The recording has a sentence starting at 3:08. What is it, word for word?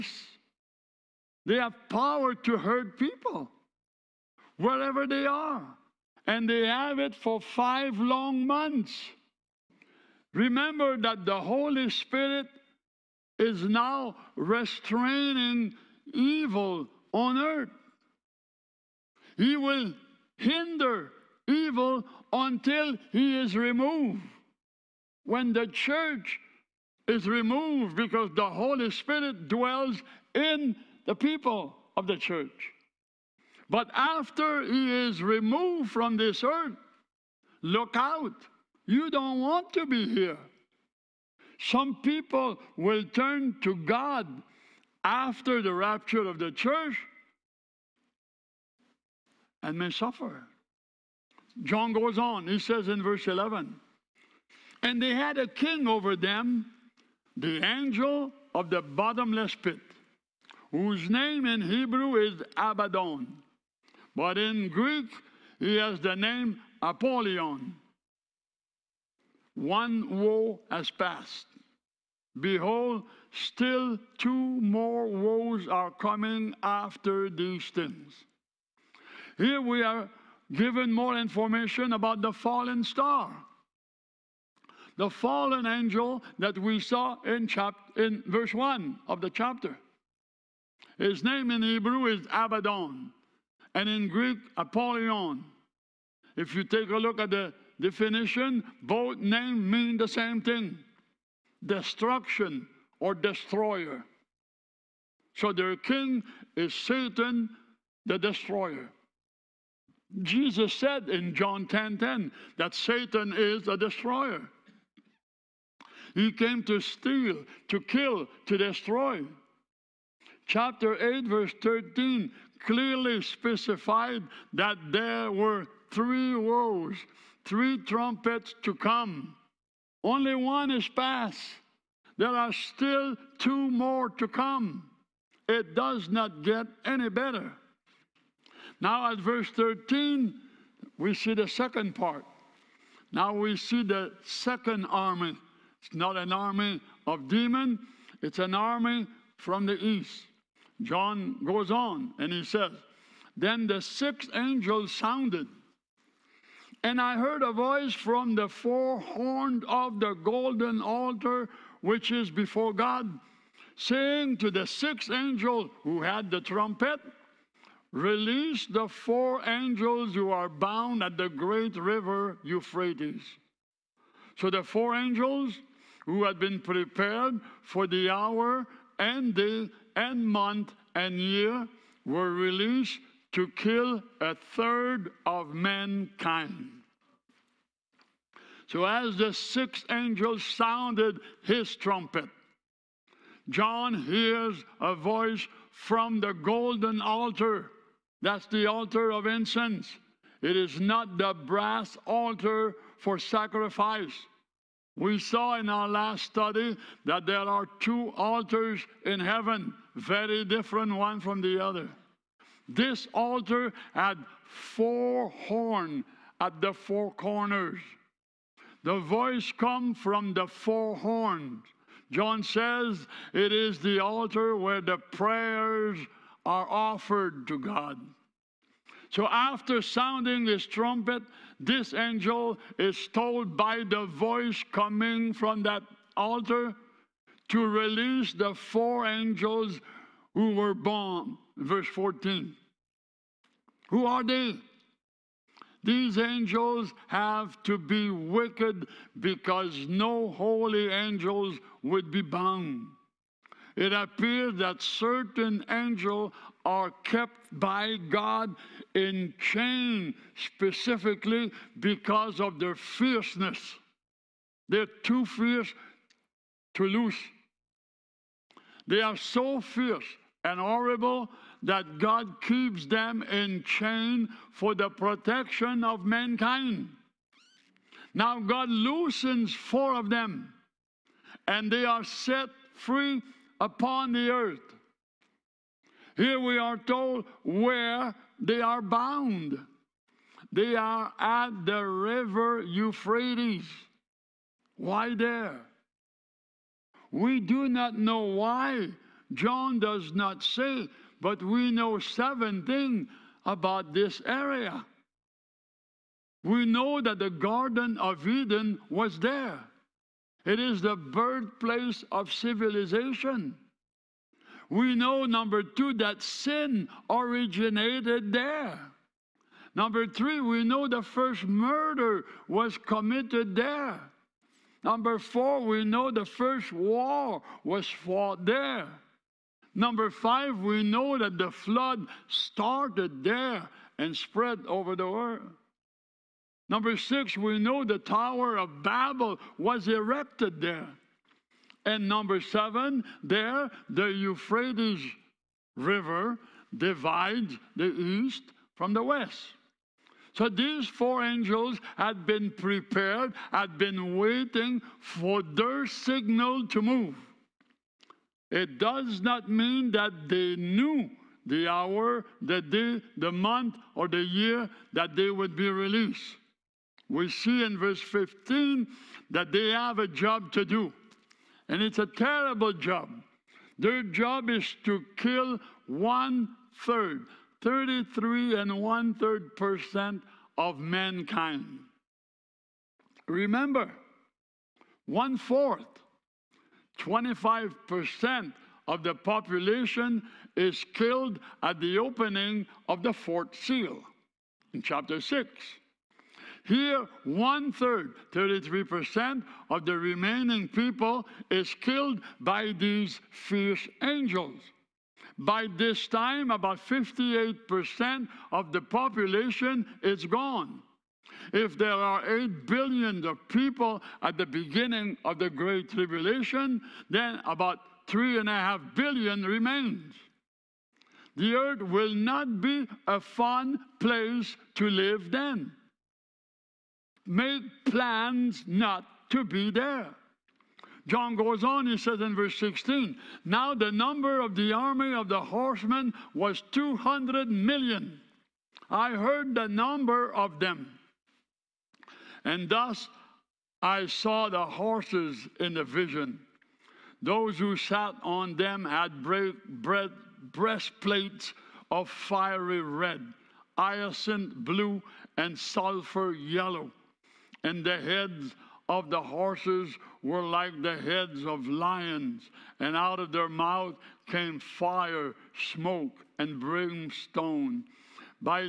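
So, as the sixth angel sounded his trumpet, John hears a voice from the golden altar.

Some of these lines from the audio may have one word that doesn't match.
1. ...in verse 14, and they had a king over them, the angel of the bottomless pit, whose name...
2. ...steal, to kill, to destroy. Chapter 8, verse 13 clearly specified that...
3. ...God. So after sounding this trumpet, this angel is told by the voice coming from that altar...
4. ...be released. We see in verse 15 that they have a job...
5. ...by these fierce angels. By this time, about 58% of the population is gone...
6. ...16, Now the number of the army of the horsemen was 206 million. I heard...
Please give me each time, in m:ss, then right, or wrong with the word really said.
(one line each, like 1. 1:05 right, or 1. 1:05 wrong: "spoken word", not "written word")
1. 0:52 wrong: "11", not "14"
2. 1:56 right
3. 3:47 right
4. 6:05 right
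5. 6:42 right
6. 7:12 wrong: "200", not "206".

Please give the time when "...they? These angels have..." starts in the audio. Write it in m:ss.
4:04.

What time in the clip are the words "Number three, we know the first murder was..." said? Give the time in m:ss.
5:19.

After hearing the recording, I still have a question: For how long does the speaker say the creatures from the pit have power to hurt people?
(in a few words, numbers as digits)
5 months.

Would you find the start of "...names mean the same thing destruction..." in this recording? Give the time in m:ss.
1:39.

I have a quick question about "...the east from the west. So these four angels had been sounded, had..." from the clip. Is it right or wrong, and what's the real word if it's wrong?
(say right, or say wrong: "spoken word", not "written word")
wrong: "prepared", not "sounded".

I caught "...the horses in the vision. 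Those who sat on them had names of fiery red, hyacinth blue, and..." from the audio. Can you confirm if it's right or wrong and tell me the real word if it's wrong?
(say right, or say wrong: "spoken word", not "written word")
wrong: "breastplates", not "names".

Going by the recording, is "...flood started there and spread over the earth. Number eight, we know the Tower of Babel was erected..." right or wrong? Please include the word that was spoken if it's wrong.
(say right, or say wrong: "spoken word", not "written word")
wrong: "six", not "eight".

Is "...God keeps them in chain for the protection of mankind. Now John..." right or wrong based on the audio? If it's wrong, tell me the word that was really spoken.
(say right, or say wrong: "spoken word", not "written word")
wrong: "God", not "John".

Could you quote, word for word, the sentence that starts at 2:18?
Now, at verse 13, we see the second part.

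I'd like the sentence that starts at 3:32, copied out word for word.
This altar had four horns at the four corners.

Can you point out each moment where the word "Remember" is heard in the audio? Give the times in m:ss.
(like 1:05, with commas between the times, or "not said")
0:10, 6:23.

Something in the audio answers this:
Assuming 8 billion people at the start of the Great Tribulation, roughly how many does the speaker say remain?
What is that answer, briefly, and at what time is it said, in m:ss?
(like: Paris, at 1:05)
3.5 billion, at 6:58.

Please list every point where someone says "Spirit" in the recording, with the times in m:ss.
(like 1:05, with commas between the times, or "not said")
0:11, 0:28.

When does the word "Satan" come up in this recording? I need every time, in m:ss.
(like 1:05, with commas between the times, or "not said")
1:46, 1:52.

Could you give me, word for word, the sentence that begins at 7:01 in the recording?
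The earth will not be a fun place to live then.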